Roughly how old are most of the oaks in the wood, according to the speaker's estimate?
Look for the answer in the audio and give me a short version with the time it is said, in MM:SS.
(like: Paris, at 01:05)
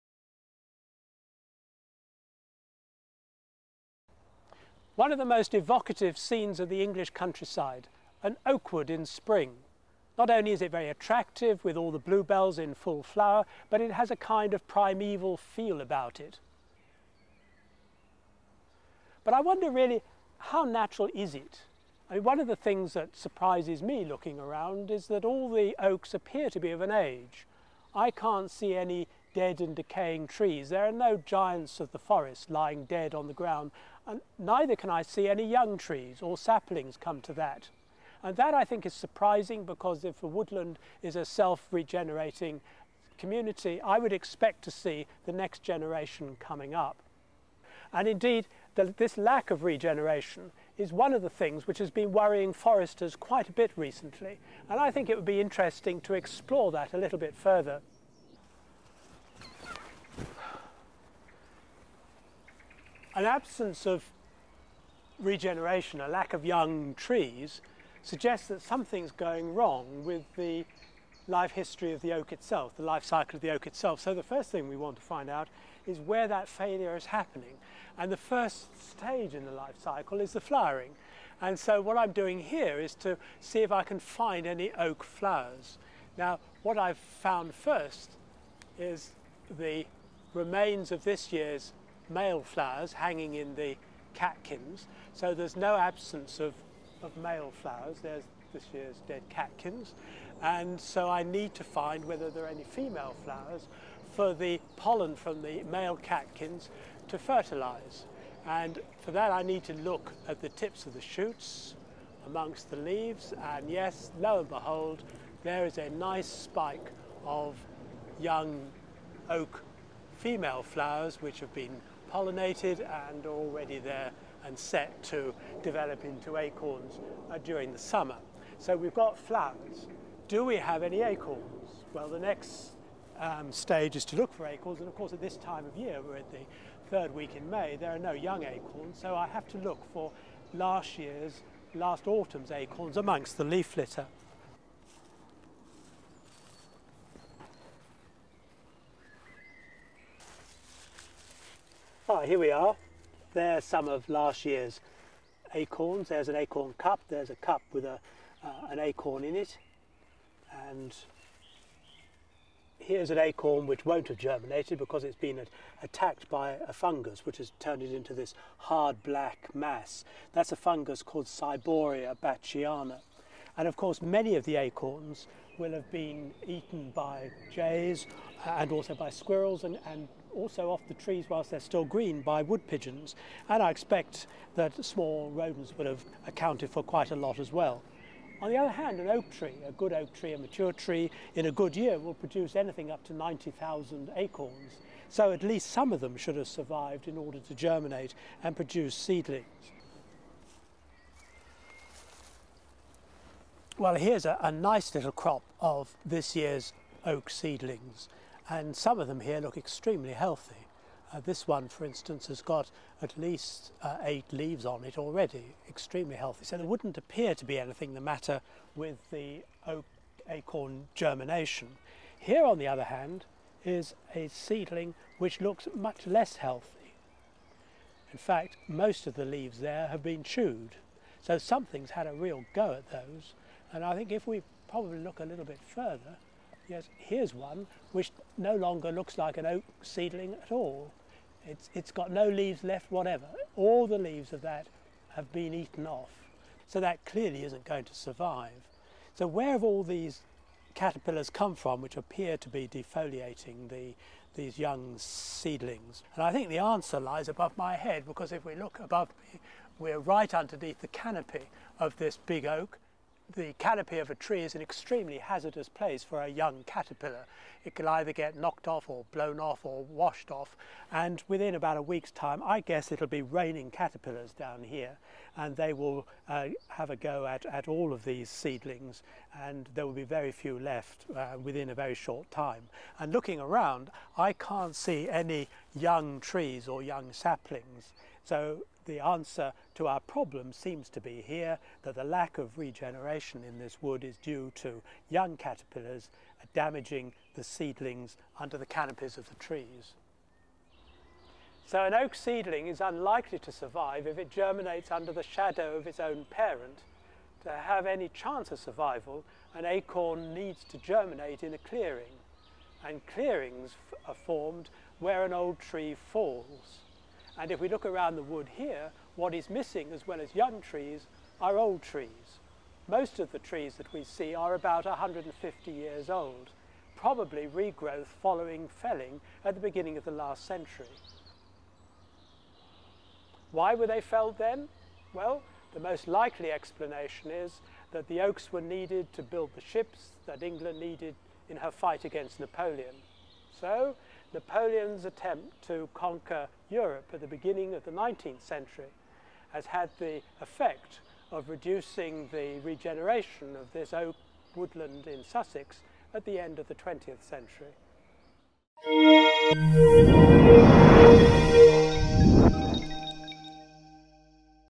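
150 years, at 05:24.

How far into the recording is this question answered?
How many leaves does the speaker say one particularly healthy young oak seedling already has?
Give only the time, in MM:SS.
03:34.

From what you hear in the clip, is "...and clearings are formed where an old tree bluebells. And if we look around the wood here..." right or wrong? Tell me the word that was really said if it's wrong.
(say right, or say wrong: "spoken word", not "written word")
wrong: "falls", not "bluebells".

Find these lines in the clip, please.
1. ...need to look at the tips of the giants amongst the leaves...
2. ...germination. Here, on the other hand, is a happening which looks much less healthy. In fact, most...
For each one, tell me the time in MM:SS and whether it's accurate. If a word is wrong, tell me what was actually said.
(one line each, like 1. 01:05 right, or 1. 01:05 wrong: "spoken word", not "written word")
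1. 01:49 wrong: "shoots", not "giants"
2. 03:40 wrong: "seedling", not "happening".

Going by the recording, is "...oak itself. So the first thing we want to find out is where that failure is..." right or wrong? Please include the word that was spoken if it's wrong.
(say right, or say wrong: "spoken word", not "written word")
right.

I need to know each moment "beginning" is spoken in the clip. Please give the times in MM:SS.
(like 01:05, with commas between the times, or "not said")
05:29, 05:47.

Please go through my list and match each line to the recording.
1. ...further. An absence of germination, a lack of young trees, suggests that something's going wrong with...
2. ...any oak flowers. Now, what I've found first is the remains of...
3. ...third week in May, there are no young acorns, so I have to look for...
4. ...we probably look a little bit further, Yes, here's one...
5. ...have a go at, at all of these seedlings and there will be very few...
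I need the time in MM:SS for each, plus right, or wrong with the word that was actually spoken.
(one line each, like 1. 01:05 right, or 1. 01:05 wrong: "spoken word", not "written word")
1. 00:57 wrong: "regeneration", not "germination"
2. 01:24 right
3. 02:16 right
4. 03:54 right
5. 04:36 right.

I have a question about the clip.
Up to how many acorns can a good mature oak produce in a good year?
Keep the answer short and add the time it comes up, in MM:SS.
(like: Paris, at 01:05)
90,000, at 03:13.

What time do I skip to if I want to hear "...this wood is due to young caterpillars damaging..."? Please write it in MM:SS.
04:53.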